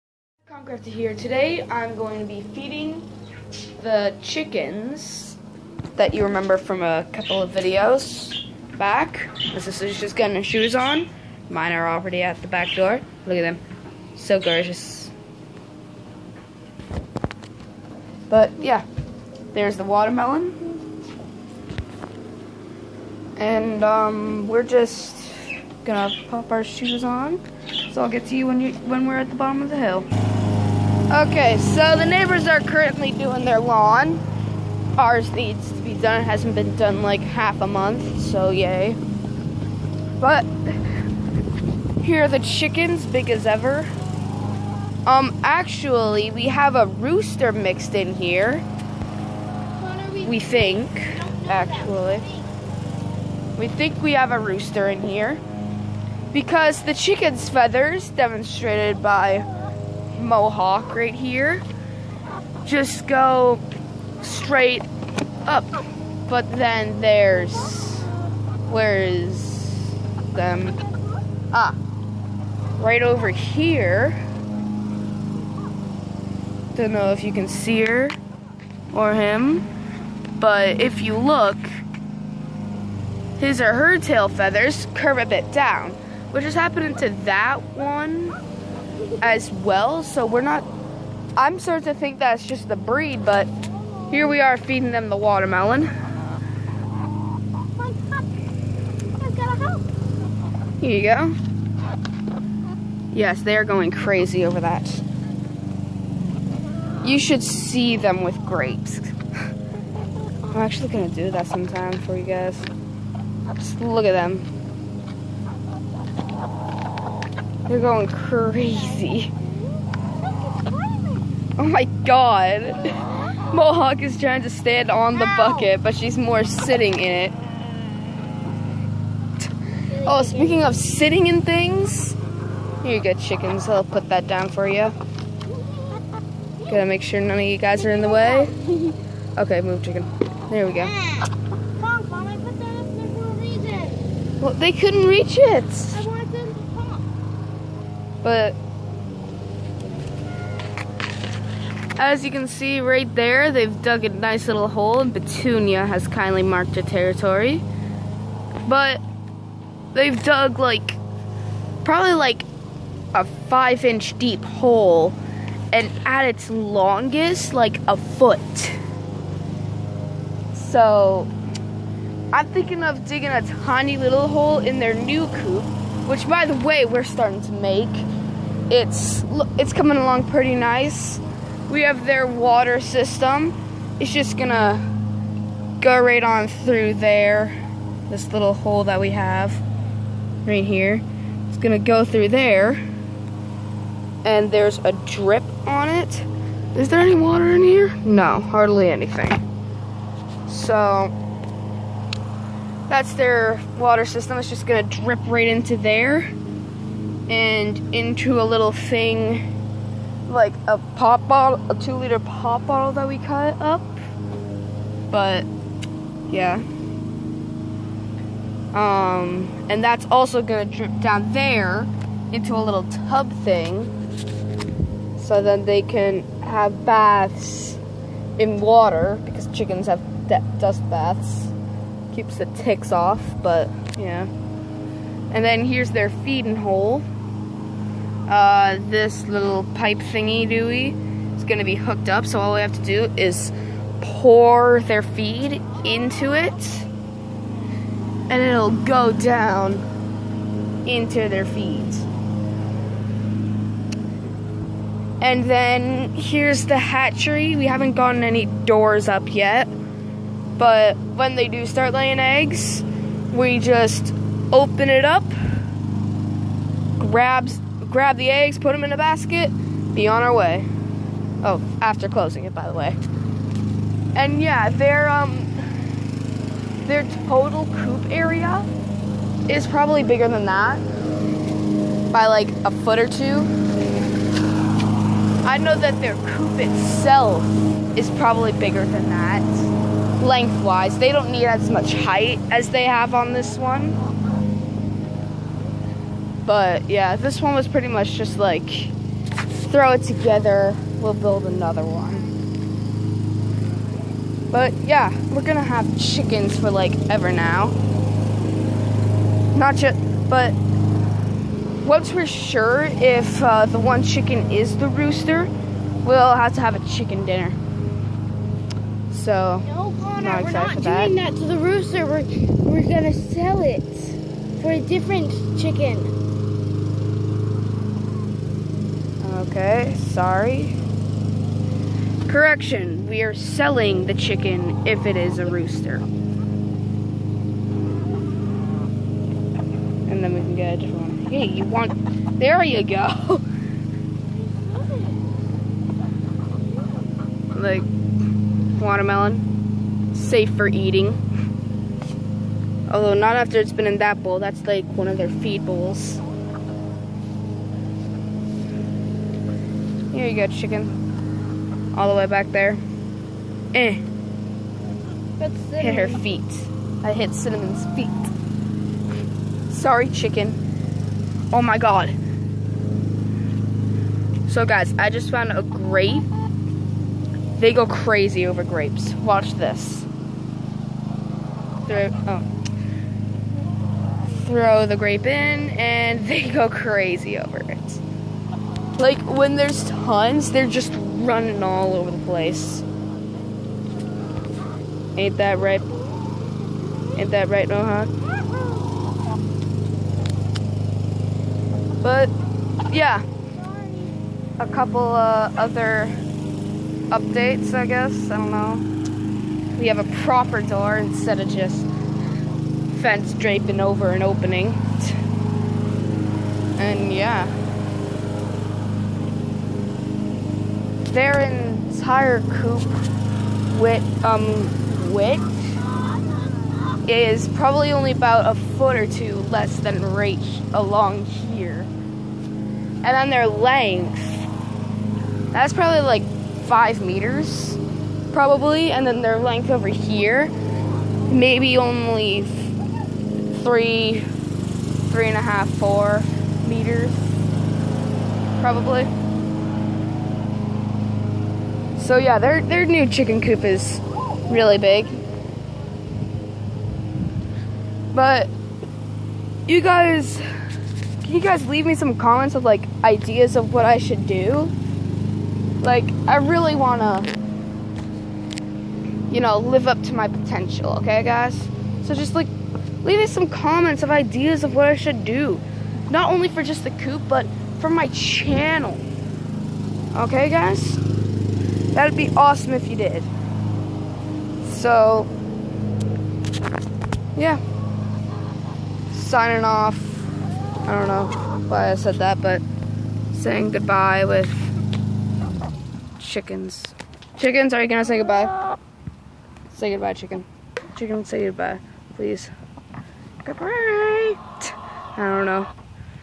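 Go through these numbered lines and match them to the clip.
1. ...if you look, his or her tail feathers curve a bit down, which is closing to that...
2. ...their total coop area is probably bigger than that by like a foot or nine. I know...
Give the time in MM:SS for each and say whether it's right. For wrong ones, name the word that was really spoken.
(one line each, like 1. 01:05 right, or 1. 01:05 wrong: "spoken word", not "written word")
1. 01:20 wrong: "happening", not "closing"
2. 04:36 wrong: "two", not "nine".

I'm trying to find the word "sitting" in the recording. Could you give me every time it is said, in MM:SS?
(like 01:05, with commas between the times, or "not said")
02:06, 02:10.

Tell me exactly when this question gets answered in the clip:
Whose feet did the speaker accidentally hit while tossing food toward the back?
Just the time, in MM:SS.
06:07.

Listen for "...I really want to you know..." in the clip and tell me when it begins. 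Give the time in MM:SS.
07:46.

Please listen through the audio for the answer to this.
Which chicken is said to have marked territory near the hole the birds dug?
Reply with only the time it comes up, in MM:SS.
02:35.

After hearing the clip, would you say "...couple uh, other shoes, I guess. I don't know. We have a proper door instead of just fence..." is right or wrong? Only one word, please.
wrong.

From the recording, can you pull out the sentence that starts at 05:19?
So, no, Connor, not we're not doing that.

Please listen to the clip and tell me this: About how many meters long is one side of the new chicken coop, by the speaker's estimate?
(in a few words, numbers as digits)
5 meters.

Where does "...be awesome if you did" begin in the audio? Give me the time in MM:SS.
08:02.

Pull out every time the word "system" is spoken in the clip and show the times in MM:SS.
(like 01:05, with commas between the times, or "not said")
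03:02, 03:24.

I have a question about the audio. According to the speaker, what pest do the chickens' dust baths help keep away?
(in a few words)
ticks.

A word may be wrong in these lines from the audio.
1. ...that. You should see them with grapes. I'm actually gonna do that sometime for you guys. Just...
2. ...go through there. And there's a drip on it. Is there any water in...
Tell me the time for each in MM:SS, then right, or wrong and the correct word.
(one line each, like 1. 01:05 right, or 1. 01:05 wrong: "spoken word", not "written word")
1. 01:44 right
2. 03:11 right.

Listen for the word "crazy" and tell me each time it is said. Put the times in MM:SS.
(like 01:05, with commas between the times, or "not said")
01:43, 01:58, 06:17, 06:26.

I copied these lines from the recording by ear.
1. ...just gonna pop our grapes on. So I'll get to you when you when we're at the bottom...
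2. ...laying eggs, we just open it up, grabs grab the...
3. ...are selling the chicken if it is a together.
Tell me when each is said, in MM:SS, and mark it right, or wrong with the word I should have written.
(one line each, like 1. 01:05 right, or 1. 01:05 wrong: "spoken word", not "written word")
1. 00:24 wrong: "shoes", not "grapes"
2. 04:21 right
3. 05:33 wrong: "rooster", not "together".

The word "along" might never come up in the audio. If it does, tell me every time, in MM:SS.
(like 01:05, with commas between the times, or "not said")
02:59, 07:10.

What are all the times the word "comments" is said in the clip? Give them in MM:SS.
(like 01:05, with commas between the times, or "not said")
07:42, 07:53.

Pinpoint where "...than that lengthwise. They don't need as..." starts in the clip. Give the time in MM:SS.
04:48.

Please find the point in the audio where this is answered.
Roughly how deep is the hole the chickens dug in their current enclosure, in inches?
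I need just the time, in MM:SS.
02:43.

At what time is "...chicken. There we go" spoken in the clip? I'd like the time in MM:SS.
02:19.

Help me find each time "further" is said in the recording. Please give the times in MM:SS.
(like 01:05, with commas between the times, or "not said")
not said.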